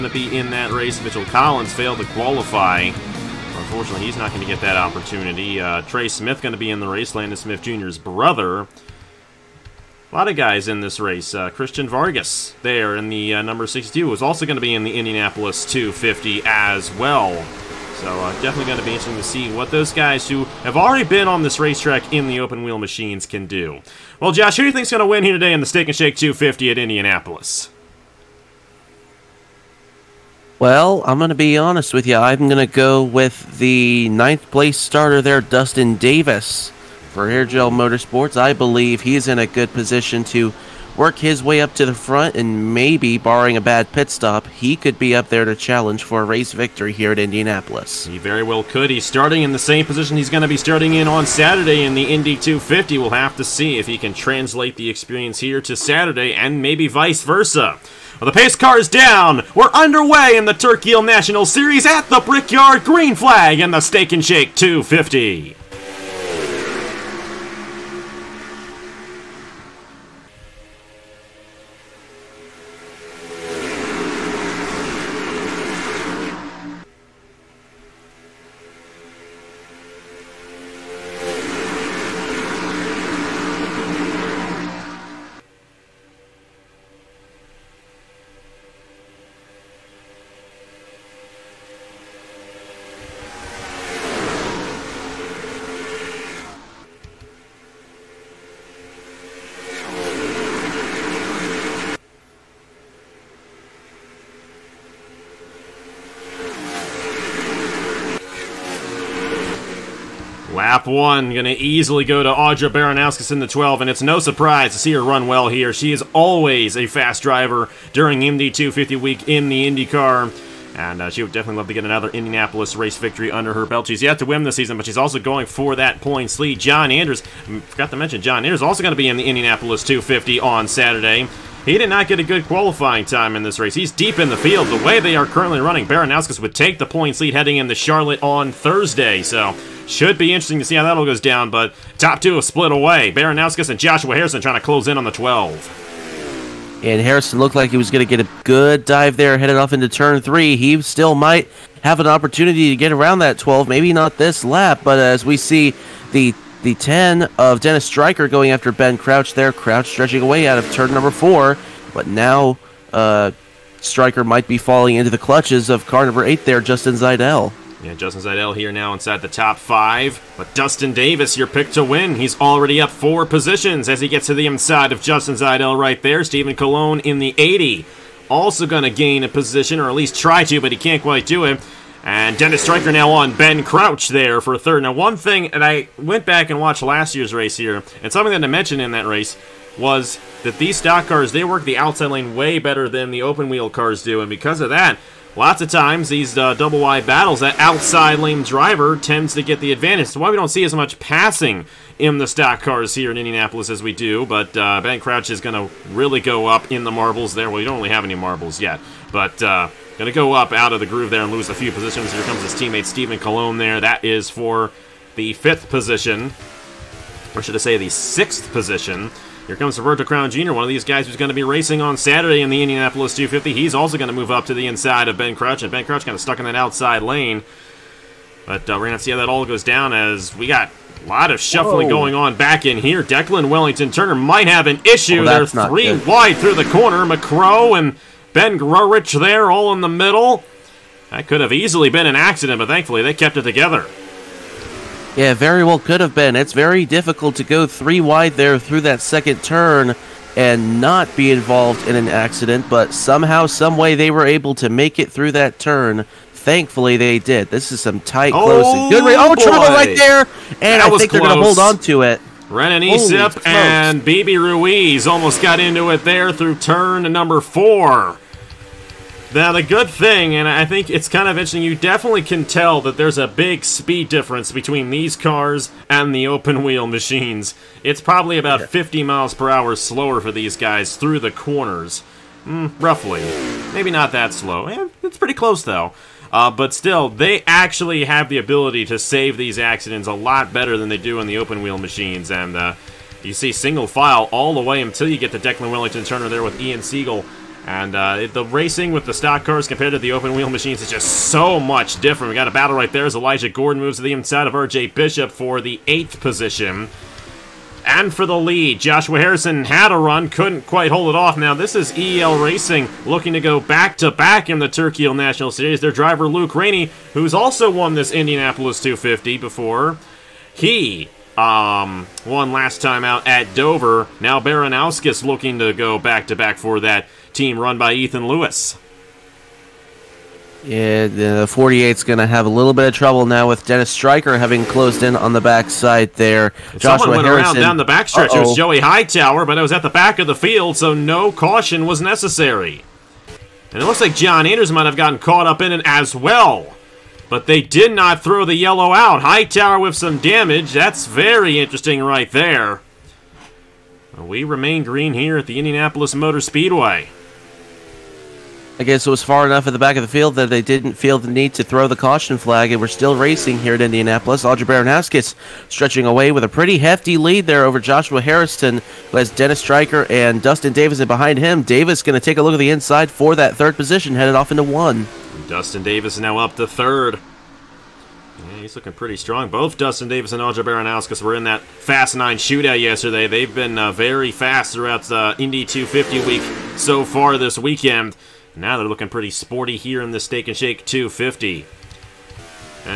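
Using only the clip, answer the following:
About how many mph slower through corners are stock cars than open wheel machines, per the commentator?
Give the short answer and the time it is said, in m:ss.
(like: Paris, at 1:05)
50, at 4:38.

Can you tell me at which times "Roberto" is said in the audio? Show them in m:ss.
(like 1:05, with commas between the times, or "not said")
3:39.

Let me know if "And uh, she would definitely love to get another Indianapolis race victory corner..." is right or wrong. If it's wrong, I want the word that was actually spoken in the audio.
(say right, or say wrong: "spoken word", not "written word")
wrong: "under", not "corner".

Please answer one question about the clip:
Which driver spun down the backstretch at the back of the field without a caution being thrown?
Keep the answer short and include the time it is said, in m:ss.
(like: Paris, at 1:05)
Joey Hightower, at 5:38.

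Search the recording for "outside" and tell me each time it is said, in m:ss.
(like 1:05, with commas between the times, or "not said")
3:11, 3:17, 3:46.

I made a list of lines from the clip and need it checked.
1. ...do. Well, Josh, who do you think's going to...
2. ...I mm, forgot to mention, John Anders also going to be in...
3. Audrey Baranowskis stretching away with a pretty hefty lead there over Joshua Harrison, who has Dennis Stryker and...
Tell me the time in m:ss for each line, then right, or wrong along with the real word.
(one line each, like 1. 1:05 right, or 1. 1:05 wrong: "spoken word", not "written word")
1. 0:23 right
2. 2:07 right
3. 6:04 right.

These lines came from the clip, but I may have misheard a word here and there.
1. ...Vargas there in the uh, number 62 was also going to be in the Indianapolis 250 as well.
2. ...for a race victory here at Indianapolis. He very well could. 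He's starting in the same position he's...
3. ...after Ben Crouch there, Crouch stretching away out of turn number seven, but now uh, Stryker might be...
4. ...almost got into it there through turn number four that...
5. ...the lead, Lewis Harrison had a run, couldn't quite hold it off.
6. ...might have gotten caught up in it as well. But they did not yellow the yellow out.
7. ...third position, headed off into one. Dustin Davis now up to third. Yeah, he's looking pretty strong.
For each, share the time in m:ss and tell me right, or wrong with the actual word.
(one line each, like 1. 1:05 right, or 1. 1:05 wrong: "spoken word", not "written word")
1. 0:11 right
2. 0:46 right
3. 2:38 wrong: "four", not "seven"
4. 4:25 right
5. 5:08 wrong: "Joshua", not "Lewis"
6. 5:44 wrong: "throw", not "yellow"
7. 6:13 right.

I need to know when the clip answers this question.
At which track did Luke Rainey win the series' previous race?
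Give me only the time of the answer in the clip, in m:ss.
5:23.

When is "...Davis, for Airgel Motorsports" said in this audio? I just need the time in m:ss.
0:35.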